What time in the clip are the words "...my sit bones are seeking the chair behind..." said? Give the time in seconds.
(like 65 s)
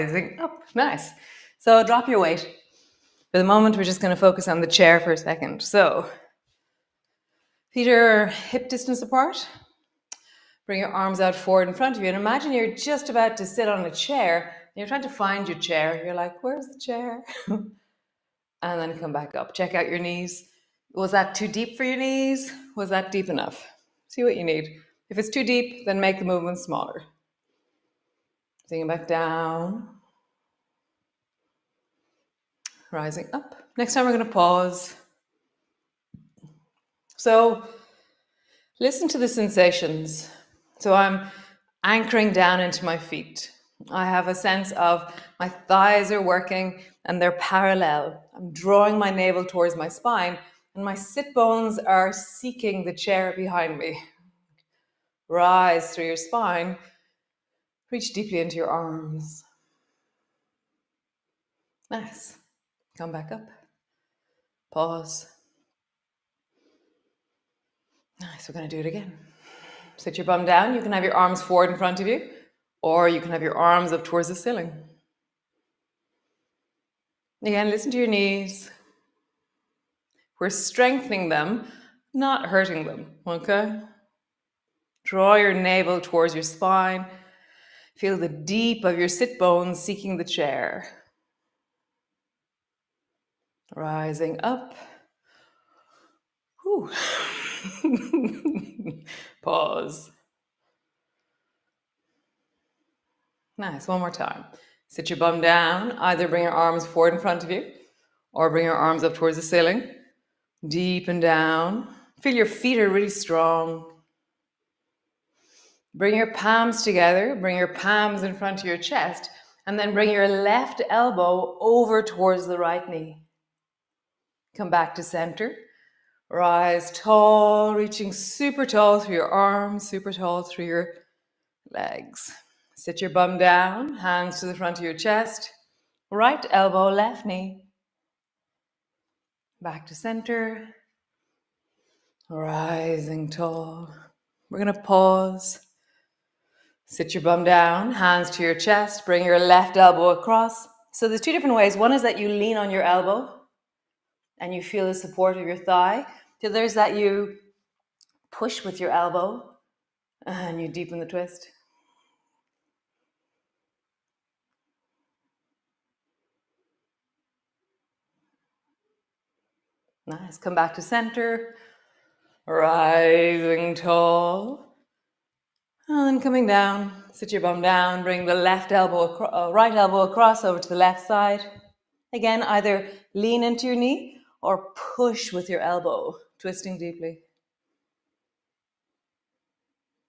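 50 s.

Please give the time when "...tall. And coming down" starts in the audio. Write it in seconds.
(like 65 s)
173 s.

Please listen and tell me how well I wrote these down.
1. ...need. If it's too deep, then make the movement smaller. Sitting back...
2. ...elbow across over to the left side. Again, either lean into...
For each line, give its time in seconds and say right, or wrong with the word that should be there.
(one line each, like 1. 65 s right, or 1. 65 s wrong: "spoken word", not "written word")
1. 24 s right
2. 179 s right.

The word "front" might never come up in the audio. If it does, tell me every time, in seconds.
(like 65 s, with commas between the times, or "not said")
11 s, 71 s, 107 s, 118 s, 134 s.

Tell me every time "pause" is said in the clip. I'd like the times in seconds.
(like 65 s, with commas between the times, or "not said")
34 s, 64 s, 99 s, 144 s.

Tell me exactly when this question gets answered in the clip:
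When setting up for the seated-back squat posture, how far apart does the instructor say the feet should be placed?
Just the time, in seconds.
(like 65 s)
8 s.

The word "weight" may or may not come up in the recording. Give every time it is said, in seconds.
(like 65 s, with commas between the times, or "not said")
2 s.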